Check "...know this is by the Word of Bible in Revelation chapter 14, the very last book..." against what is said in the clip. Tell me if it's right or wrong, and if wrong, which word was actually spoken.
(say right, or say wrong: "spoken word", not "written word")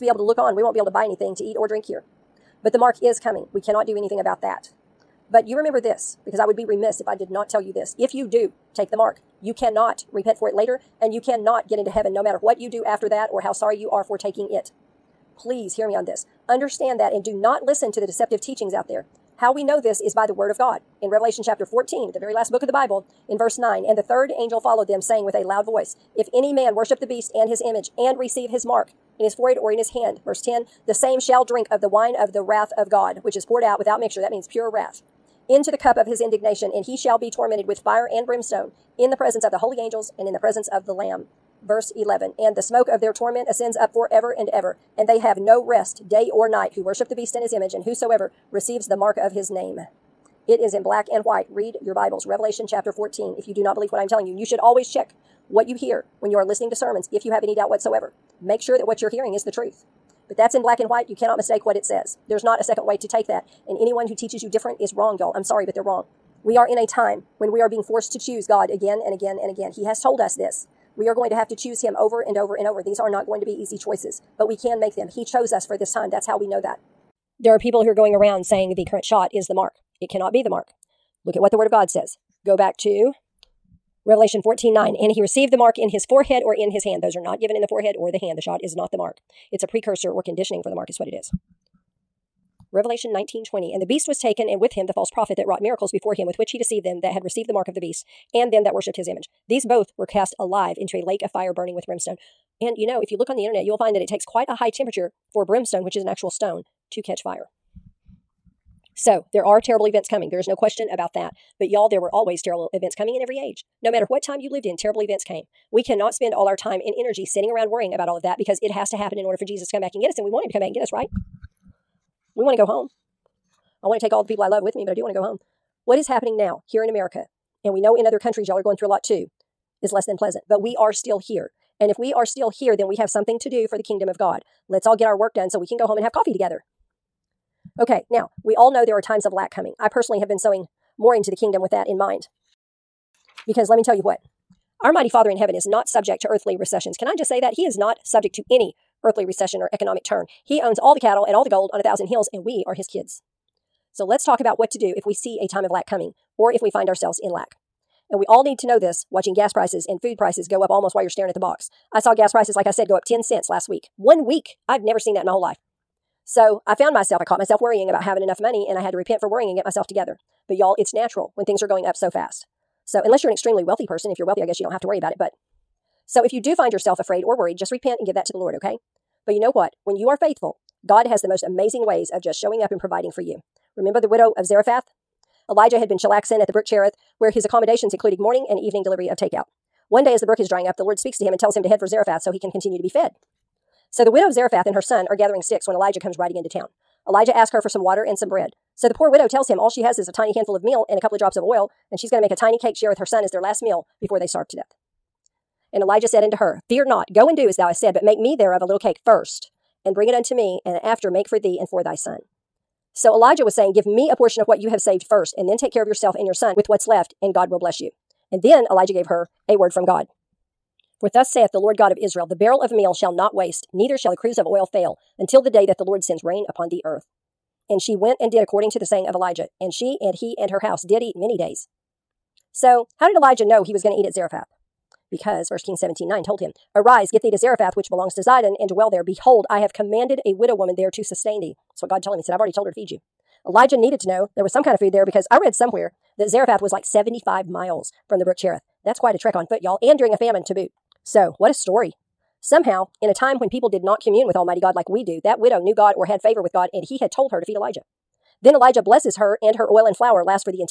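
wrong: "God", not "Bible".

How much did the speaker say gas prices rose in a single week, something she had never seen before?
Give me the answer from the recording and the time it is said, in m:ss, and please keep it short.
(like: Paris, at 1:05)
10 cents, at 2:43.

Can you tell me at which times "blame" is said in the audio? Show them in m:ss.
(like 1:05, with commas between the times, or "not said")
not said.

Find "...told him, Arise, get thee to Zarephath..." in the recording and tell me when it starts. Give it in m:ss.
3:56.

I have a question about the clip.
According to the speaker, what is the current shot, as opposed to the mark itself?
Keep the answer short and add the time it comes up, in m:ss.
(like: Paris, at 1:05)
a precursor, at 1:29.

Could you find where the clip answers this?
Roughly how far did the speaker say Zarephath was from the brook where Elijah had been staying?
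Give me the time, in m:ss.
4:06.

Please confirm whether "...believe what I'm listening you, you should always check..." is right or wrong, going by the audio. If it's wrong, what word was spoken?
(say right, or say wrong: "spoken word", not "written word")
wrong: "telling", not "listening".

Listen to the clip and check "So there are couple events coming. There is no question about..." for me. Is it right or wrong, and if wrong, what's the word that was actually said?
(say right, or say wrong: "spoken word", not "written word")
wrong: "terrible", not "couple".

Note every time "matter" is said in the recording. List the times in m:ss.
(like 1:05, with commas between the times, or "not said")
0:12, 1:53.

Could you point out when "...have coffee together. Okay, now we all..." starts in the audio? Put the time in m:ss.
2:16.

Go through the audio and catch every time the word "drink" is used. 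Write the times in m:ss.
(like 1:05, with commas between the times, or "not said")
0:01, 0:31.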